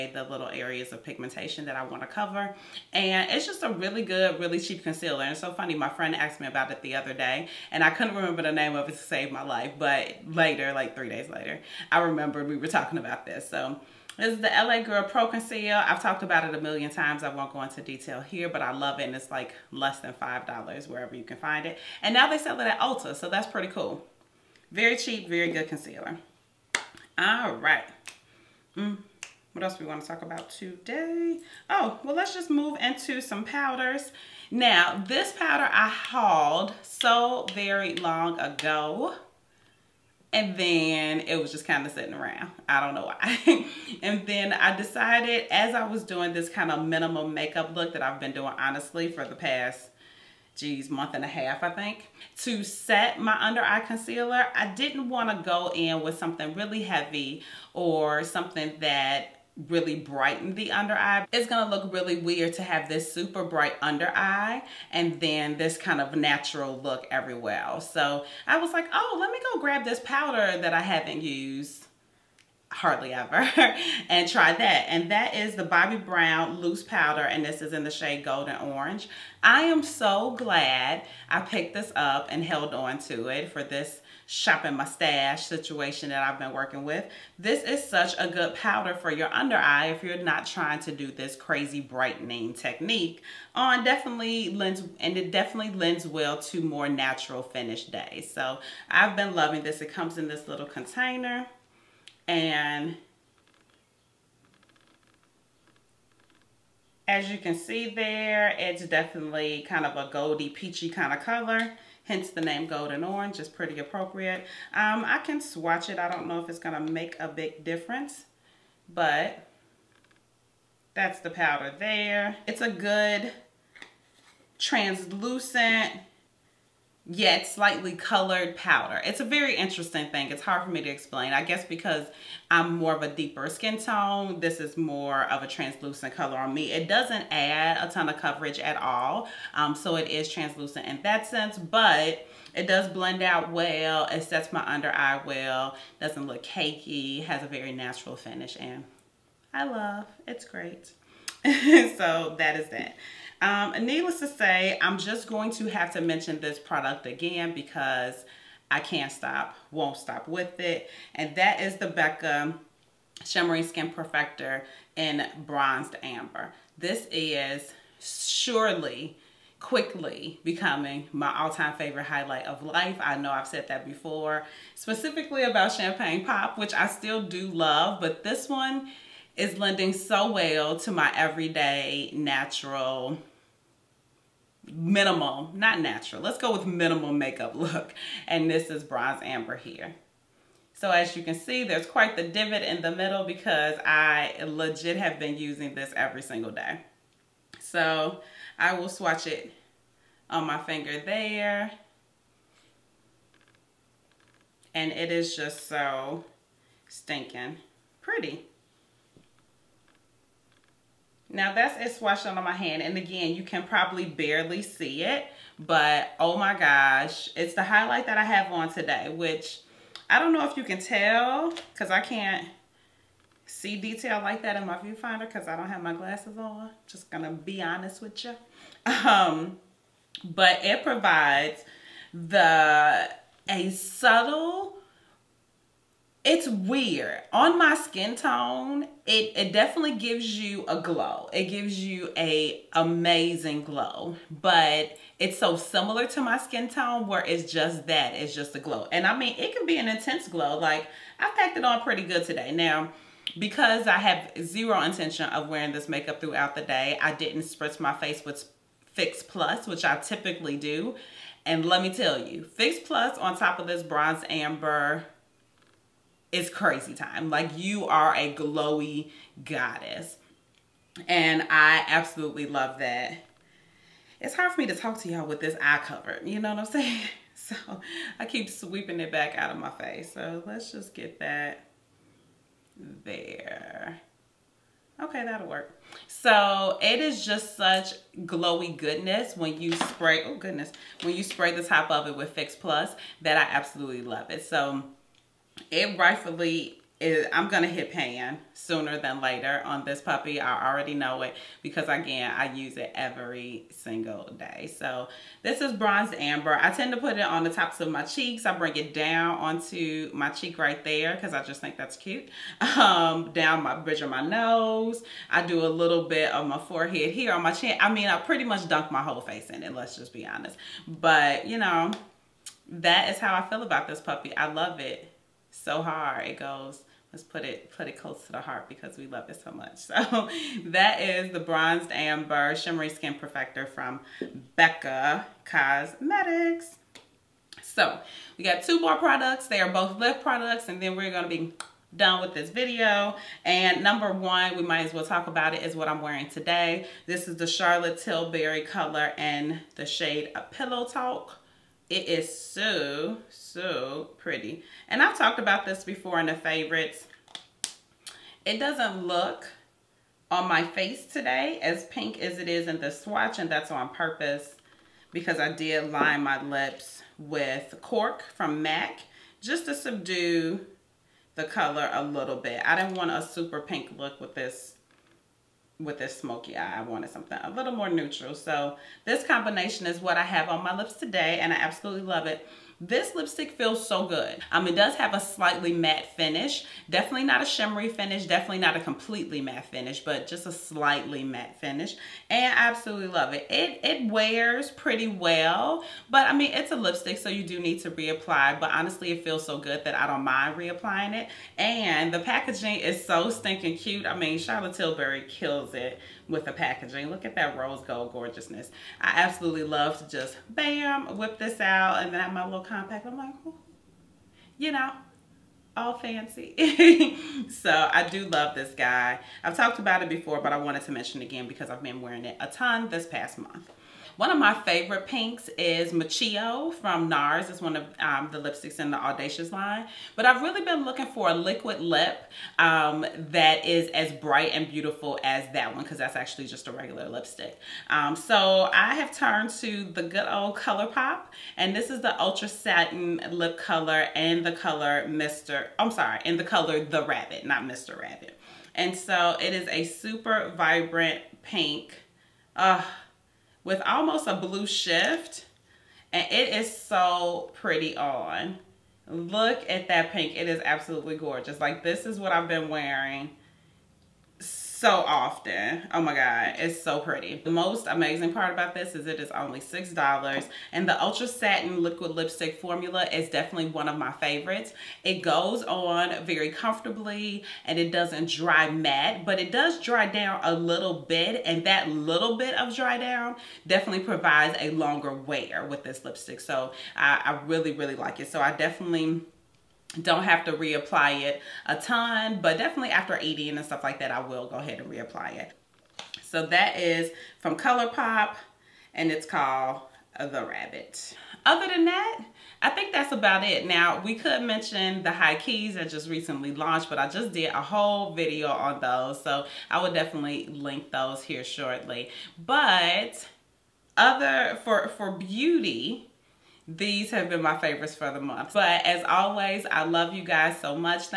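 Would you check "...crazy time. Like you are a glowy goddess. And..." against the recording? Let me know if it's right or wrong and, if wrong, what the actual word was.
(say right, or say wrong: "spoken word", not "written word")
right.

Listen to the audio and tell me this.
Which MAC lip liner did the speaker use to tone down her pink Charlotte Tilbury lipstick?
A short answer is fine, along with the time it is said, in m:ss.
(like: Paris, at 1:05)
Cork, at 6:07.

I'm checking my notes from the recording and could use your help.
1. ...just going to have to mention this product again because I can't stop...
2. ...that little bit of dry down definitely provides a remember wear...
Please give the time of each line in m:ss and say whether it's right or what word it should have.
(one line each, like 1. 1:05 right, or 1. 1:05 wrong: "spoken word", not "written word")
1. 2:34 right
2. 8:01 wrong: "longer", not "remember".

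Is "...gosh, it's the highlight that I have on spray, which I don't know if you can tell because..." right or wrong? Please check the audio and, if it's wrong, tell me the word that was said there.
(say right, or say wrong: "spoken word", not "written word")
wrong: "today", not "spray".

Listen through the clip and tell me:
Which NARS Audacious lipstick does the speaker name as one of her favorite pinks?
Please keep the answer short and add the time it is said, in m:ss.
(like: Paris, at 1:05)
Michiyo, at 7:05.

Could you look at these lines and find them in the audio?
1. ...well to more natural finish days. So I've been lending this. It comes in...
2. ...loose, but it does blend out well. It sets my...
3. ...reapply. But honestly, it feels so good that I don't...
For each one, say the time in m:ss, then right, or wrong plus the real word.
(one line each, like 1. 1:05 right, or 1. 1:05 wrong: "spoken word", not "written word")
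1. 1:36 wrong: "loving", not "lending"
2. 2:21 wrong: "sense", not "loose"
3. 6:37 right.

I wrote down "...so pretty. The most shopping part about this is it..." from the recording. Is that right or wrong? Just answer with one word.
wrong.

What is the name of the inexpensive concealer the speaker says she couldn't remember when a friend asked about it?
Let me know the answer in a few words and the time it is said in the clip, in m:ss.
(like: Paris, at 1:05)
LA Girl Pro Conceal, at 0:14.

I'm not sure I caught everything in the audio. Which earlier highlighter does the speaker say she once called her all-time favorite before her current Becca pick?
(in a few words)
Champagne Pop.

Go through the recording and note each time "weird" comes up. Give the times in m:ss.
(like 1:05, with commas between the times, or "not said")
1:02, 3:56.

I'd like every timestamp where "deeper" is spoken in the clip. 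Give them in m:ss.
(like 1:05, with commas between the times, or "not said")
2:13.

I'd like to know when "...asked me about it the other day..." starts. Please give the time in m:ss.
0:06.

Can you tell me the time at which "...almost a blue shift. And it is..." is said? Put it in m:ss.
7:33.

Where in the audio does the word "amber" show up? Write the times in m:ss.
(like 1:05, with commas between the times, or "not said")
2:46, 3:09, 4:24, 5:06, 5:31.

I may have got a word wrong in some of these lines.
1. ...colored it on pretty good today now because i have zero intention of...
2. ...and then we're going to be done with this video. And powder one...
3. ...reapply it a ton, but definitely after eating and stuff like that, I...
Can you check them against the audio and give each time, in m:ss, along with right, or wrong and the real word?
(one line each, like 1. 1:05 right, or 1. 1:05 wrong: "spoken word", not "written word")
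1. 4:11 wrong: "packed", not "colored"
2. 5:40 wrong: "number", not "powder"
3. 8:10 right.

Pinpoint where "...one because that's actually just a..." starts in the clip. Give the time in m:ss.
7:15.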